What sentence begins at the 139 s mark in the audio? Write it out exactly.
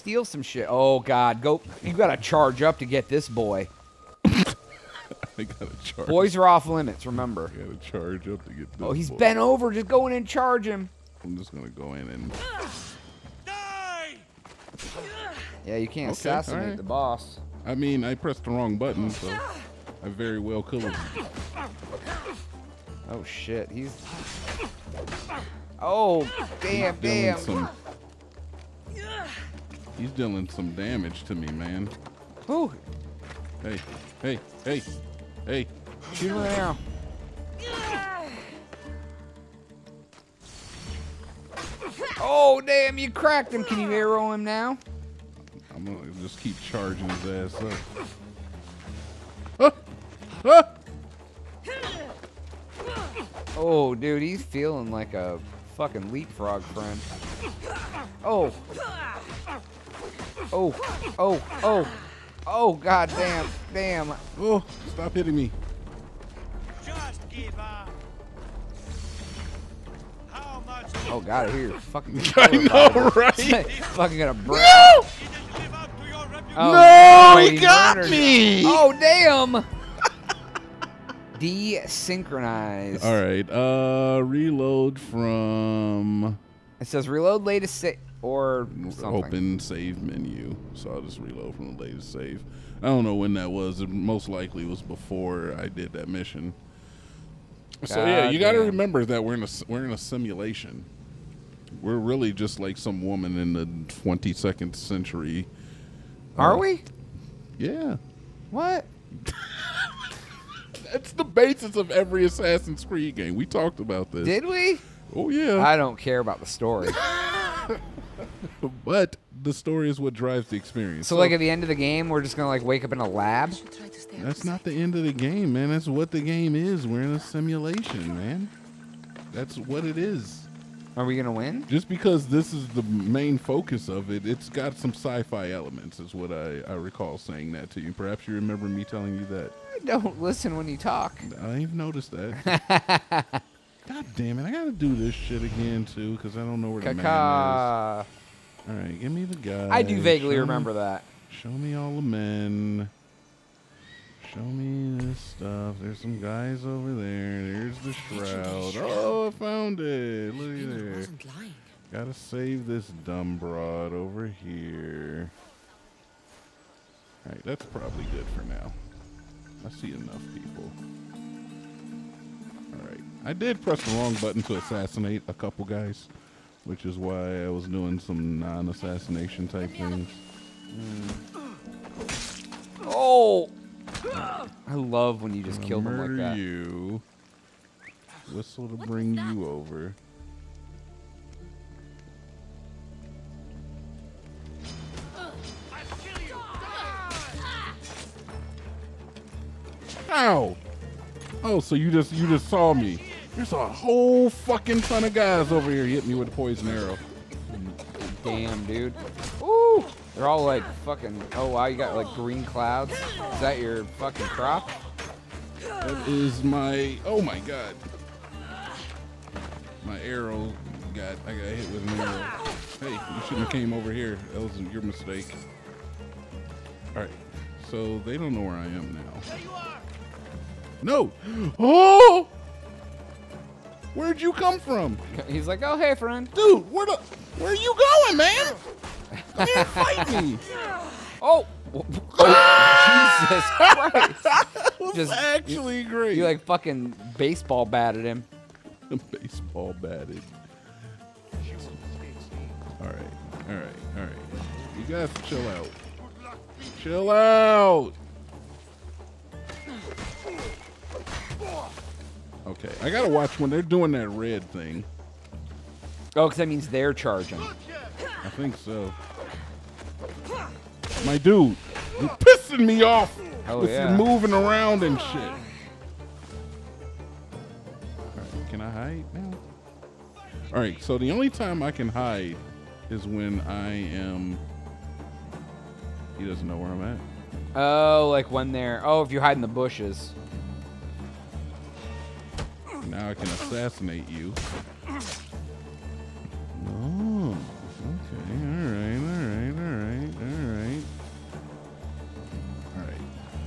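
I don't listen when you talk.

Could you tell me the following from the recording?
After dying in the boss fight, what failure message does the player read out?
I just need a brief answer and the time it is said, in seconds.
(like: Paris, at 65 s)
Desynchronize, at 81 s.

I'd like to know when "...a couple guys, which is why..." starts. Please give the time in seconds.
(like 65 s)
175 s.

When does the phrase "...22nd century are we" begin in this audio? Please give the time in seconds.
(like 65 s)
103 s.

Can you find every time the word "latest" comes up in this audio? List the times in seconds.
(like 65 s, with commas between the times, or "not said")
87 s, 91 s.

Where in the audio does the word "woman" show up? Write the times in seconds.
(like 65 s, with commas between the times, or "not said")
103 s.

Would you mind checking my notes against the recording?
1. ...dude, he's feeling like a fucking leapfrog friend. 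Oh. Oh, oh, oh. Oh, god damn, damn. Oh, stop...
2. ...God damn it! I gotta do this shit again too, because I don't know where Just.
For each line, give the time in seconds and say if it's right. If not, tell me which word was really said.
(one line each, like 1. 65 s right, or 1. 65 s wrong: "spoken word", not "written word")
1. 53 s right
2. 143 s wrong: "Caca", not "Just".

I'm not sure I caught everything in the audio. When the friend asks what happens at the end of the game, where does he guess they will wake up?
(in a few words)
In a lab.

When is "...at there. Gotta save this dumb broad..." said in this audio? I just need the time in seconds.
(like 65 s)
160 s.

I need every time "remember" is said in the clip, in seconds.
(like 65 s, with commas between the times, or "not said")
7 s, 98 s, 138 s, 150 s.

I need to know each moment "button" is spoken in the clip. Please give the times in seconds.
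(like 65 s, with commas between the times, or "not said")
18 s, 174 s.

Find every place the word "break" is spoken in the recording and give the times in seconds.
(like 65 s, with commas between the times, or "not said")
74 s.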